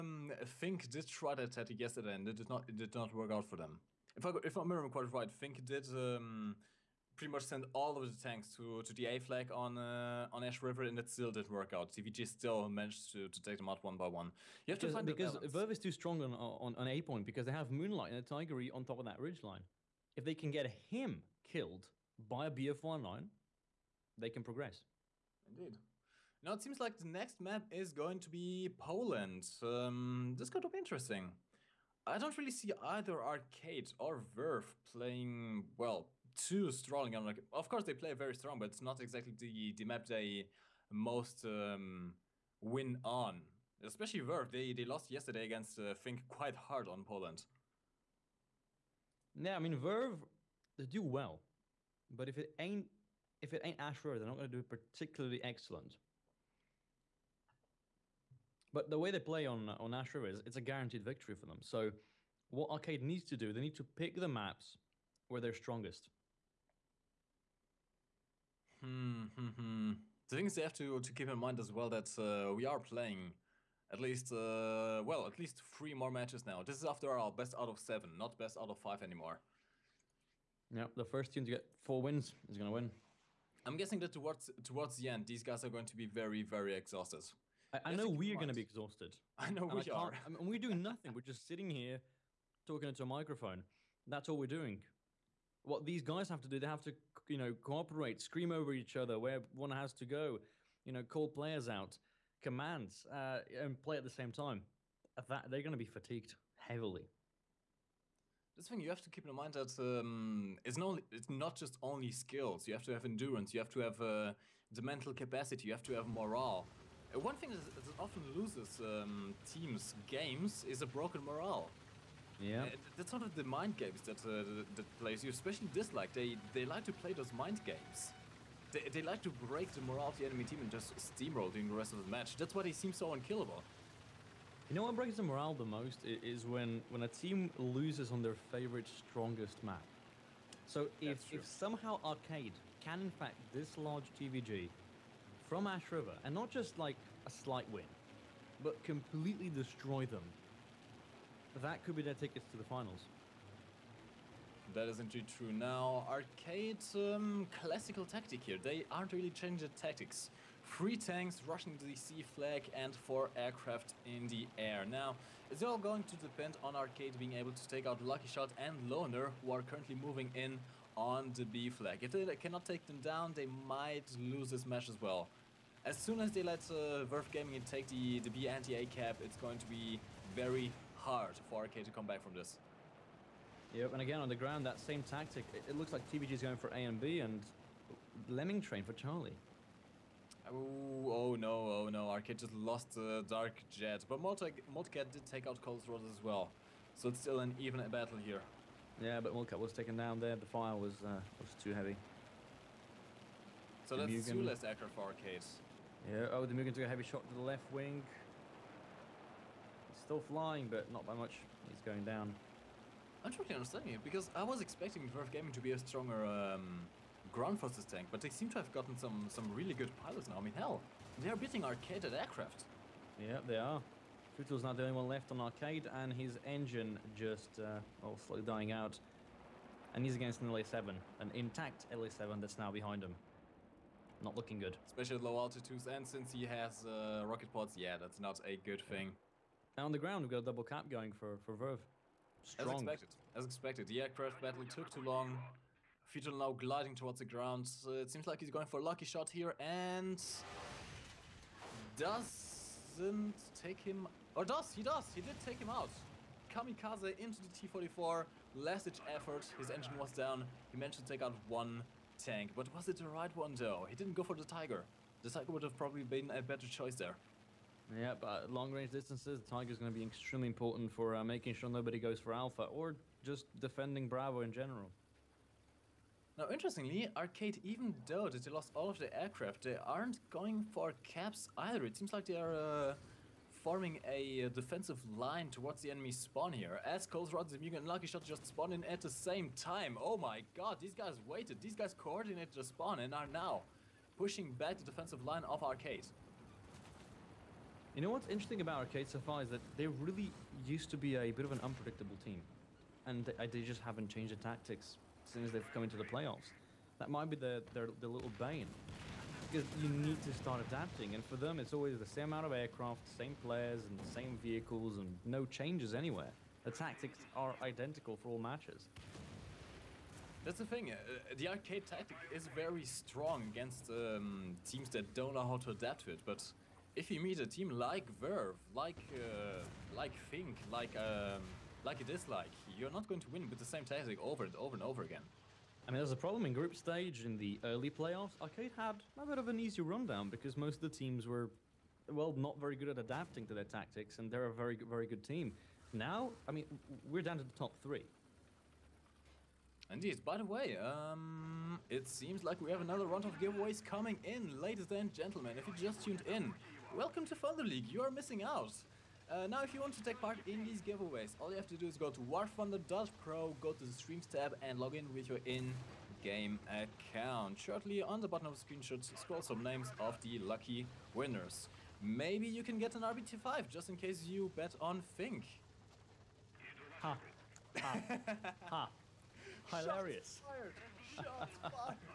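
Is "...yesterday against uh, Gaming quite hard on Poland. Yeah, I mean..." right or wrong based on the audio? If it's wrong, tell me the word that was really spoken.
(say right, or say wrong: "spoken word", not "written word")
wrong: "Fink", not "Gaming".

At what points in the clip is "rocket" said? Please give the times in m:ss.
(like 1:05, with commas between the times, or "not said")
3:57.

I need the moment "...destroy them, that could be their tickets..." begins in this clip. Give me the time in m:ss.
2:29.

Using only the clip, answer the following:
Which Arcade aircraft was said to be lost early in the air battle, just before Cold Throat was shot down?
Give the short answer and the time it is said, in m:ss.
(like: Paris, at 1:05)
Dark Jet, at 3:13.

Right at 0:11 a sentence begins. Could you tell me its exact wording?
TVG still managed to, to take them out one by one.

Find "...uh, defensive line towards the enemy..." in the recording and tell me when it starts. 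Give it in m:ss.
4:44.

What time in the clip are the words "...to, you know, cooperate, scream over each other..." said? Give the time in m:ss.
1:36.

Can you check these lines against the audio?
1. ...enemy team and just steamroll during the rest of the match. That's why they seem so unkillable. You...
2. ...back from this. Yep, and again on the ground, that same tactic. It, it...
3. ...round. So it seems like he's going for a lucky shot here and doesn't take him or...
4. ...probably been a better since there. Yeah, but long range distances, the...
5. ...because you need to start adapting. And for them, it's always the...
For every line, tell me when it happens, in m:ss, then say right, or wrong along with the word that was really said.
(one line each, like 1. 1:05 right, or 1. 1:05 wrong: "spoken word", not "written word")
1. 2:10 right
2. 3:02 right
3. 4:07 wrong: "ground", not "round"
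4. 4:25 wrong: "choice", not "since"
5. 5:09 right.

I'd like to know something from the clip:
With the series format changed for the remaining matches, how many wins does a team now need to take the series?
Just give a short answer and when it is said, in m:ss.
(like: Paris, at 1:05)
4, at 1:21.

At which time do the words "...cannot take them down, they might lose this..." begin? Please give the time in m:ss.
2:52.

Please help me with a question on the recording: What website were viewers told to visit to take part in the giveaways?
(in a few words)
warthunder.pro.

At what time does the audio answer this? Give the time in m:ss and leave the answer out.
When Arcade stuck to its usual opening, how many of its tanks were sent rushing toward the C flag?
2:40.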